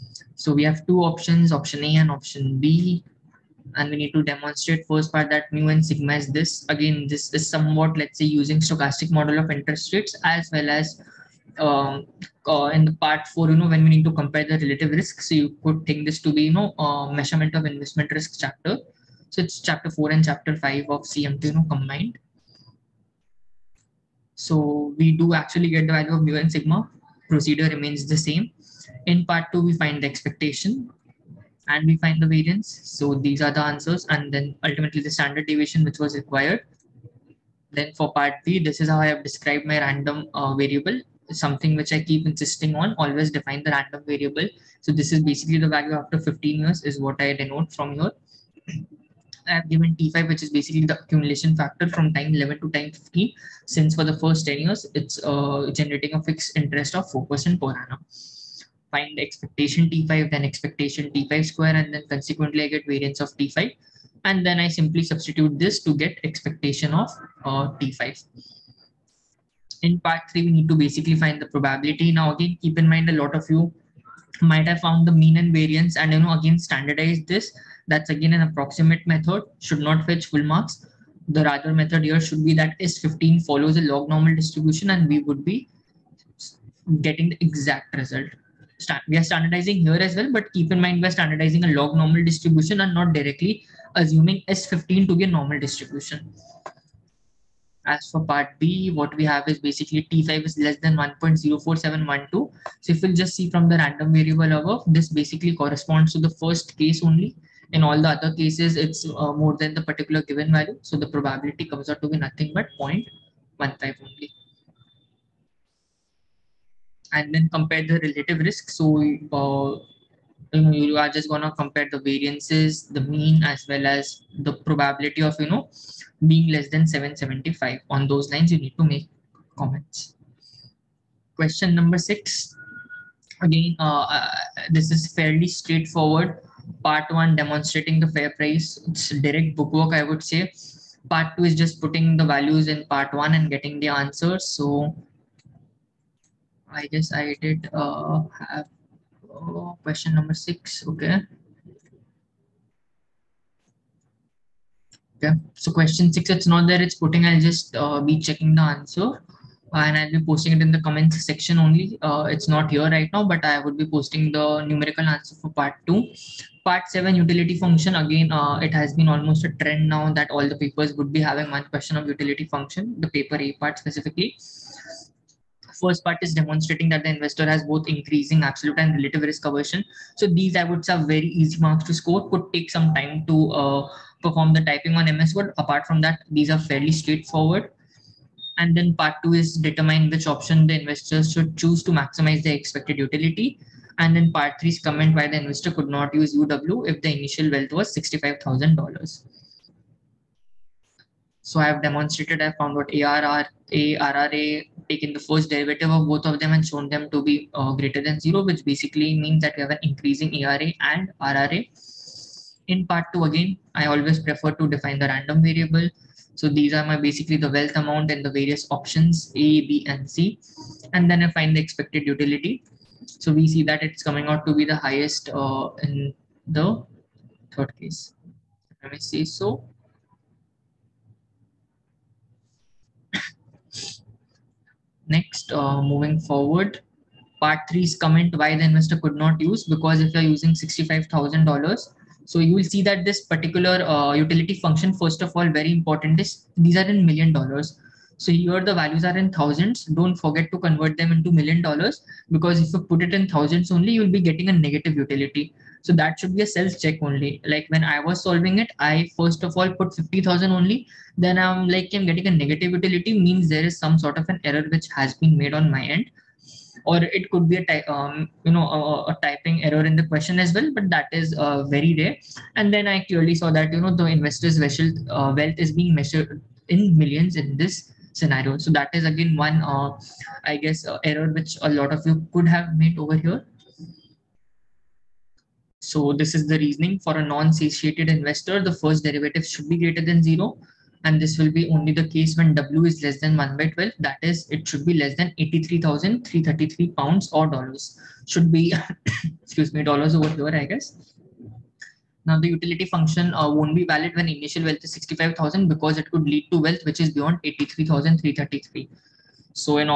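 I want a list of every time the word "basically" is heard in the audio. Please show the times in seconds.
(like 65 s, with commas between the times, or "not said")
45 s, 50 s, 70 s, 99 s, 105 s, 208 s, 216 s.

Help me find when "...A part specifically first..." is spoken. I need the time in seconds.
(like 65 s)
173 s.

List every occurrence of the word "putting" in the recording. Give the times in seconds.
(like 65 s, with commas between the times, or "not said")
141 s, 156 s.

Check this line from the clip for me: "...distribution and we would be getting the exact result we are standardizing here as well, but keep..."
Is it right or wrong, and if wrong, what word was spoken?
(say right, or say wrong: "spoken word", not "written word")
right.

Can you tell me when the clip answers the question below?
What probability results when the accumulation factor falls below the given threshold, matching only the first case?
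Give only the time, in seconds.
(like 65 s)
112 s.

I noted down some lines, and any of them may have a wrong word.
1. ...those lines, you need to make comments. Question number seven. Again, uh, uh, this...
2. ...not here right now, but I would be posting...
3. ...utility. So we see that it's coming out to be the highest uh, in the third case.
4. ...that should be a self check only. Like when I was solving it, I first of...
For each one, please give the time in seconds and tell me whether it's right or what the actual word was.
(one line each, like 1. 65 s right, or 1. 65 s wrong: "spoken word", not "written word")
1. 128 s wrong: "six", not "seven"
2. 162 s right
3. 222 s right
4. 255 s right.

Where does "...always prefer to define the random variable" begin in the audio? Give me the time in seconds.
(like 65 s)
213 s.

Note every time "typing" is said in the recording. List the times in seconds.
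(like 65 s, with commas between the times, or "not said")
184 s, 269 s.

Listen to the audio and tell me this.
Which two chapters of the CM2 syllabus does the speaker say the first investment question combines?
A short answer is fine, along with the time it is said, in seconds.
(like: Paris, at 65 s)
Chapter 4 and chapter 5, at 19 s.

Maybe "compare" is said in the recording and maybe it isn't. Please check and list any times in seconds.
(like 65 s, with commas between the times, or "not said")
14 s, 117 s, 121 s.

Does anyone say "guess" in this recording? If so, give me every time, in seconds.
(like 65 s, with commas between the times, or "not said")
146 s, 280 s, 300 s.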